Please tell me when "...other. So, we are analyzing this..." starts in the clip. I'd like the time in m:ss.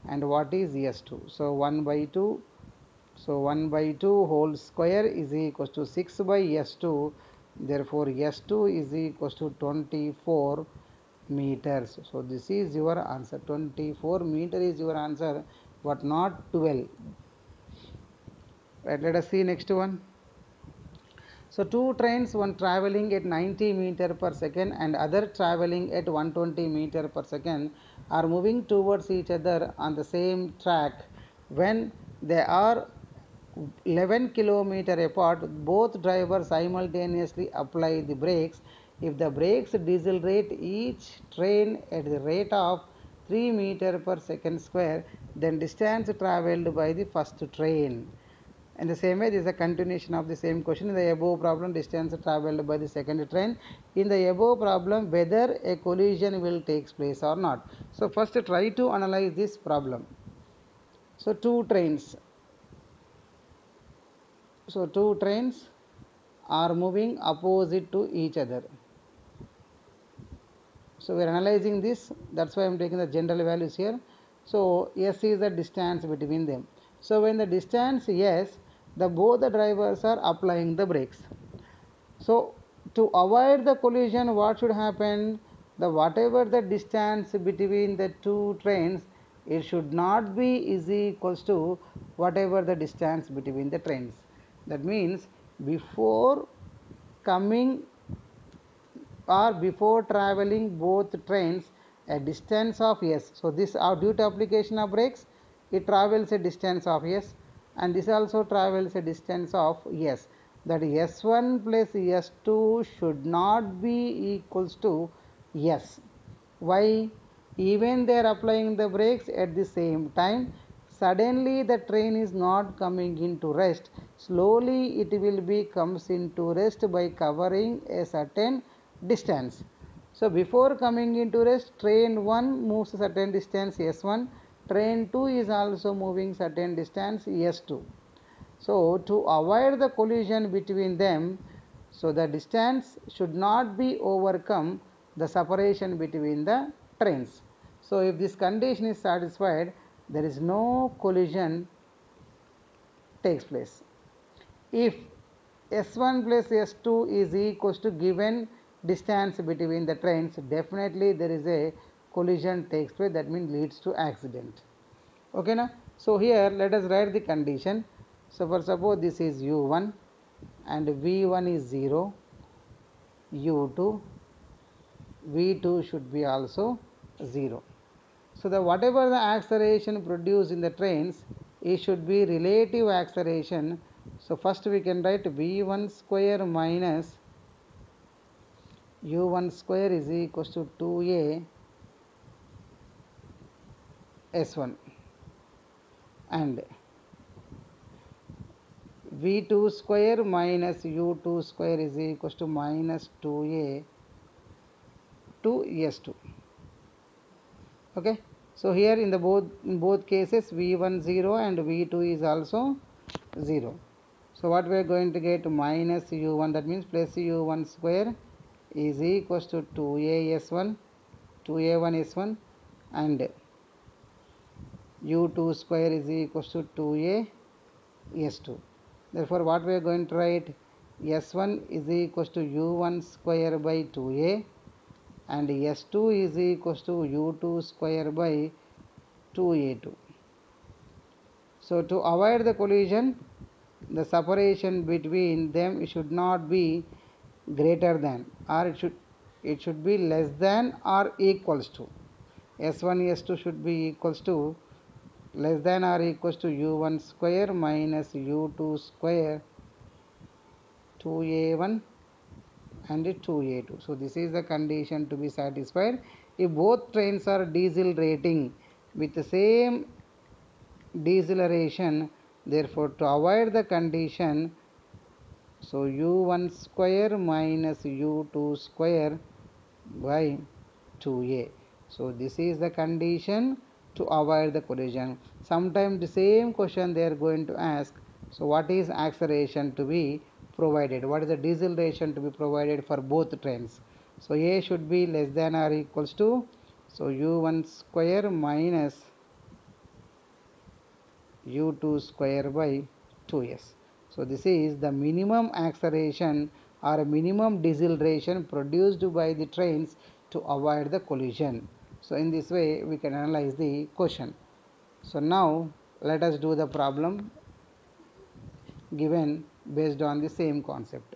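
1:08.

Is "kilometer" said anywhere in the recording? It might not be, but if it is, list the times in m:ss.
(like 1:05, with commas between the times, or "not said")
0:34.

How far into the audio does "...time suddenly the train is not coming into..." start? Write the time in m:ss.
2:00.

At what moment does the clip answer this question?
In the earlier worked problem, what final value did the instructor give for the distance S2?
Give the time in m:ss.
0:09.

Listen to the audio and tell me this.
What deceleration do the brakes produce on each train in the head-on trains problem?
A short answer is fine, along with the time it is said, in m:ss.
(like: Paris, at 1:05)
3 m/s², at 0:43.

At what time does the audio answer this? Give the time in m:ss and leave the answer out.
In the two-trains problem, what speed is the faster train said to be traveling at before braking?
0:26.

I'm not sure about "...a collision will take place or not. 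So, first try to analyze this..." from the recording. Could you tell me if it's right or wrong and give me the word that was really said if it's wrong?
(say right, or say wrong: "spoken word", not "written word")
right.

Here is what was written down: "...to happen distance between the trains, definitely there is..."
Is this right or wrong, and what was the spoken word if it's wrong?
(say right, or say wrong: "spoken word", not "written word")
wrong: "given", not "happen".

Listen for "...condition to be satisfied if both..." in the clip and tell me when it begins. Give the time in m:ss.
4:24.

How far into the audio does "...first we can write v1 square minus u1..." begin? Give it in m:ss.
3:04.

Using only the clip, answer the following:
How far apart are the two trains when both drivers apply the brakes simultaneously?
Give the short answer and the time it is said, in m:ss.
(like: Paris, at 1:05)
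11 km, at 0:33.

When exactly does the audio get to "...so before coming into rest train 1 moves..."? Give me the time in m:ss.
2:10.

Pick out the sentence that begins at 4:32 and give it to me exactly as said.
Therefore, to avoid the condition, so u1 square minus u2 square by 2a.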